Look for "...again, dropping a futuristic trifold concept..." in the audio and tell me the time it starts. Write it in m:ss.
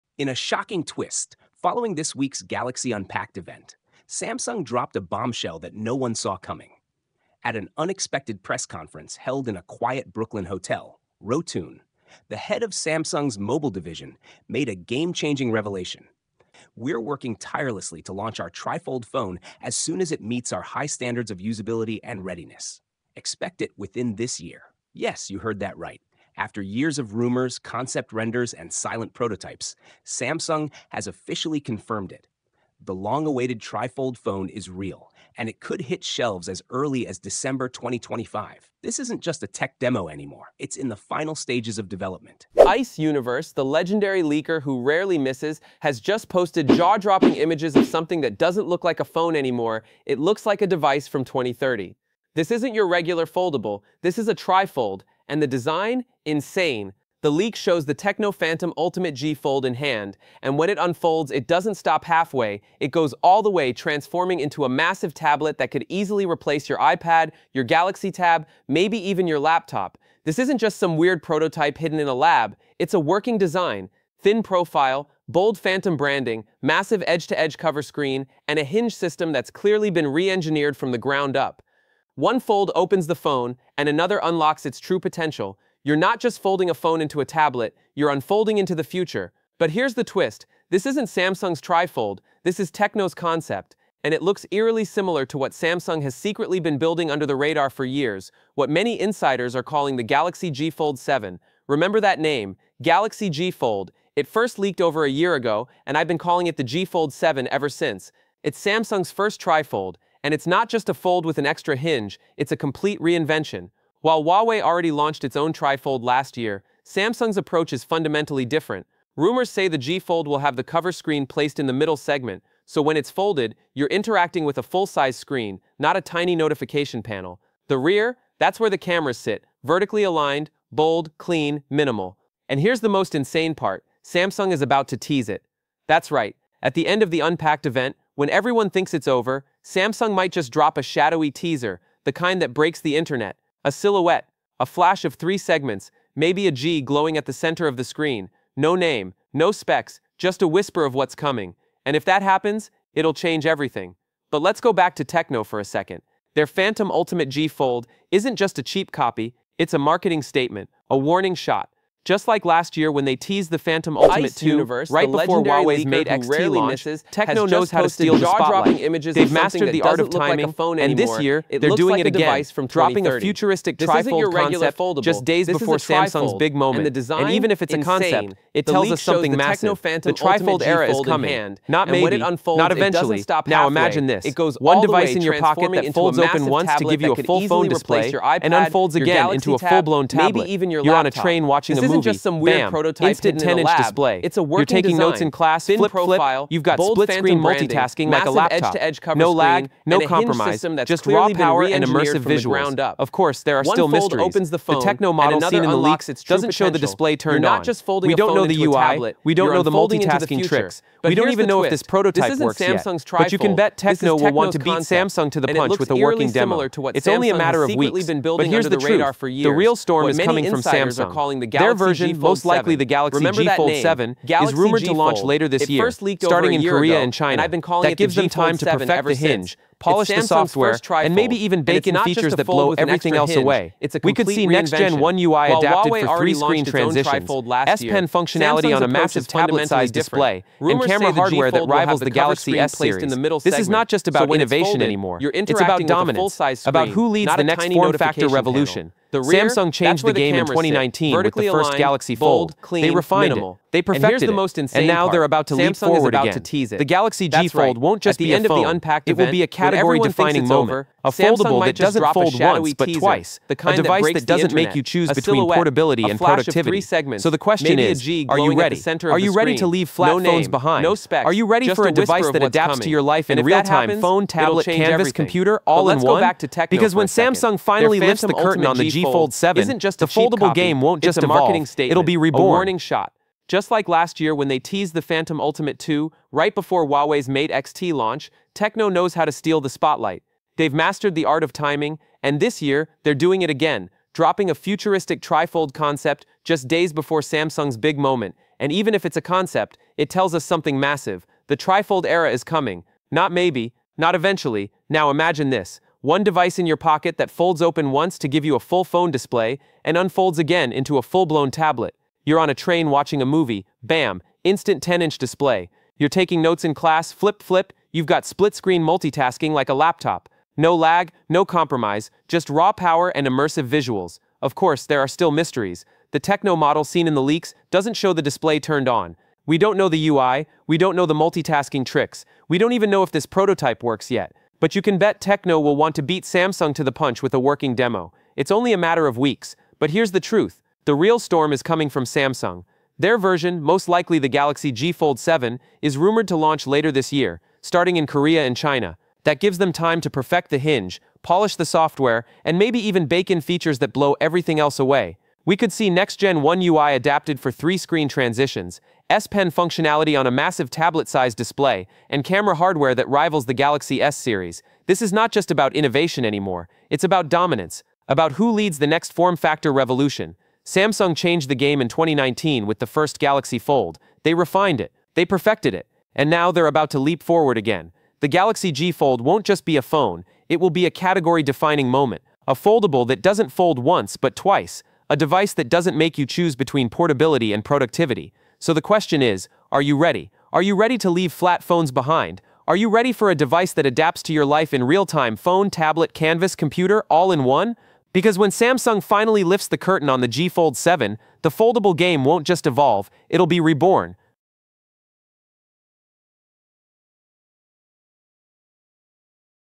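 4:53.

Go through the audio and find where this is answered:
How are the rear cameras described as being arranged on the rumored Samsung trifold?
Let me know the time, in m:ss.
2:09.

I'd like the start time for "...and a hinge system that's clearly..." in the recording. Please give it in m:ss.
1:18.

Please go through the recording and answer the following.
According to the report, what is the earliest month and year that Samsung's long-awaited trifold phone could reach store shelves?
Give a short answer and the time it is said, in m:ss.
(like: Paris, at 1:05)
December 2025, at 0:37.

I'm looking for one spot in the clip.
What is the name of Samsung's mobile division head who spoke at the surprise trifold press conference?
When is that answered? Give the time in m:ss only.
0:11.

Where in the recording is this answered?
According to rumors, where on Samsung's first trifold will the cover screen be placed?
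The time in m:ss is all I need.
2:01.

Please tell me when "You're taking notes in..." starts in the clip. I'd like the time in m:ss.
5:15.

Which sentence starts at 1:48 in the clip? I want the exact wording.
It's Samsung's first trifold, and it's not just a fold with an extra hinge, it's a complete reinvention.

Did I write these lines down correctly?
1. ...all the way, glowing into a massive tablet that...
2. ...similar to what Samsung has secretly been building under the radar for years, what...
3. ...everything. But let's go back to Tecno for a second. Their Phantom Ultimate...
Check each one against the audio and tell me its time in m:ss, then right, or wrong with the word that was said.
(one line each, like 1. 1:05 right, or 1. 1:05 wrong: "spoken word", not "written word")
1. 1:03 wrong: "transforming", not "glowing"
2. 1:34 right
3. 2:33 right.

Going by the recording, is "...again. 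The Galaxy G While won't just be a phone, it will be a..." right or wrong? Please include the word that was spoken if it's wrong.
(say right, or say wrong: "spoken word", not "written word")
wrong: "Fold", not "While".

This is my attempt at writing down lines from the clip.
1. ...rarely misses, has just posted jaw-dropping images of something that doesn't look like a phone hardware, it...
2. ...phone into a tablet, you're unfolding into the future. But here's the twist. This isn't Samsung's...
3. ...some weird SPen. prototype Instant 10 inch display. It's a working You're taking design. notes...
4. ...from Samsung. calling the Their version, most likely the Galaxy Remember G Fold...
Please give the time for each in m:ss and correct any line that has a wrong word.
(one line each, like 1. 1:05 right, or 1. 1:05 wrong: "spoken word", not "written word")
1. 0:44 wrong: "anymore", not "hardware"
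2. 1:26 right
3. 3:12 wrong: "Bam", not "SPen"
4. 3:40 right.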